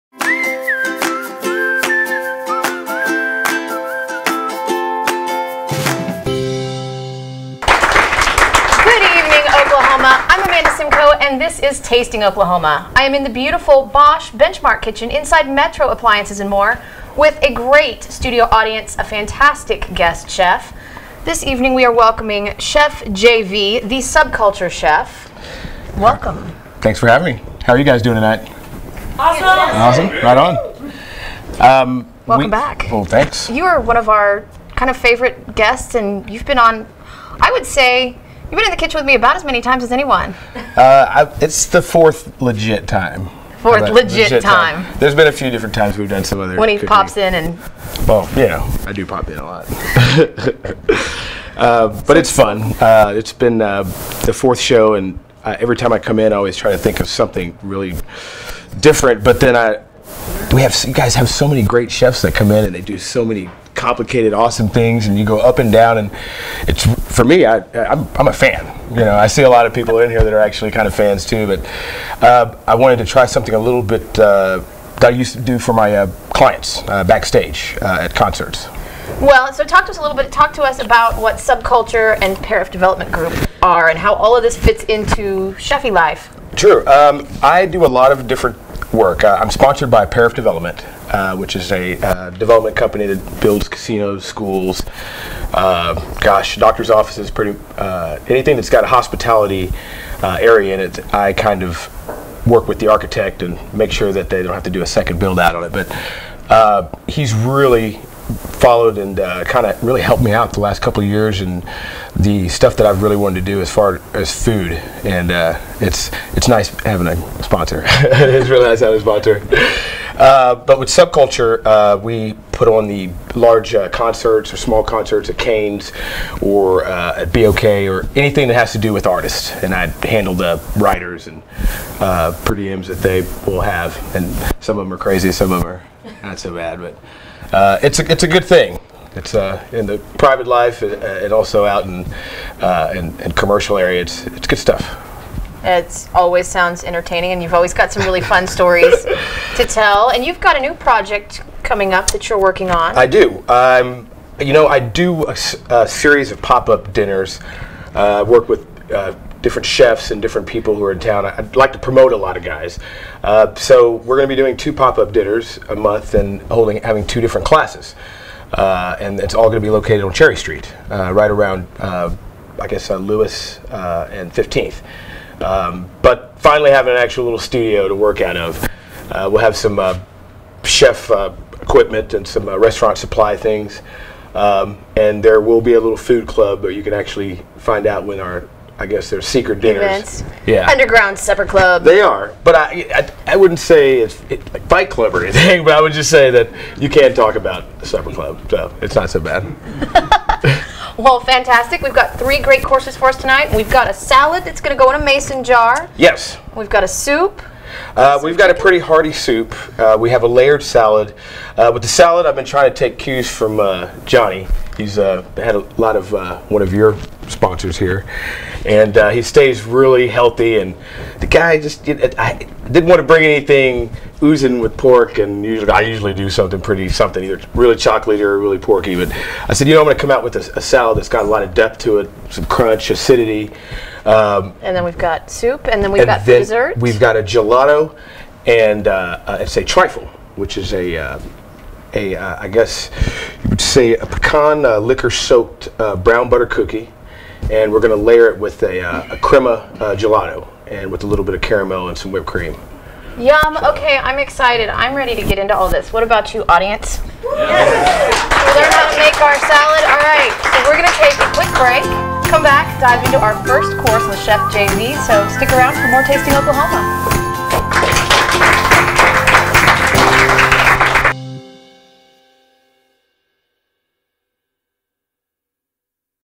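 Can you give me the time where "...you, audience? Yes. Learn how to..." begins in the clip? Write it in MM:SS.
04:16.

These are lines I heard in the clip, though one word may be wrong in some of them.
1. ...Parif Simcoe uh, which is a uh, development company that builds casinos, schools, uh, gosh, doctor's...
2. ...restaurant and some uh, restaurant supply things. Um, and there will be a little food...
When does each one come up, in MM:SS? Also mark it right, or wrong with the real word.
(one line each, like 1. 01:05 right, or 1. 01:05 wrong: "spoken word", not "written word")
1. 01:30 wrong: "Development", not "Simcoe"
2. 03:01 wrong: "equipment", not "restaurant".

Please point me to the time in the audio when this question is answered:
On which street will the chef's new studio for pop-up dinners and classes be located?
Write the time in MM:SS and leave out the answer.
02:50.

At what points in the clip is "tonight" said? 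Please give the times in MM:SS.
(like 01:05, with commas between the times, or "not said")
00:28, 03:23.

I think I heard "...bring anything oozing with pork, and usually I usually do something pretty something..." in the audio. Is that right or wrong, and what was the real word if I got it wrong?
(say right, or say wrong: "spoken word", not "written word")
right.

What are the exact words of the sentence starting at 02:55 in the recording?
Um, but finally, having an actual little studio to work out of.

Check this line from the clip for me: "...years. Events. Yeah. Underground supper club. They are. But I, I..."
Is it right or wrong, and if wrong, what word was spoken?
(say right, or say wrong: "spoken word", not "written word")
wrong: "dinners", not "years".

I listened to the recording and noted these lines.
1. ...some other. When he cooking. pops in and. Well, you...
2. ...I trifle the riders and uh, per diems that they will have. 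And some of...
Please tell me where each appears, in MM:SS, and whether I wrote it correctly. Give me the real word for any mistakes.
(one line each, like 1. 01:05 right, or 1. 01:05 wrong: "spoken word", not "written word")
1. 00:46 right
2. 02:09 wrong: "handle", not "trifle".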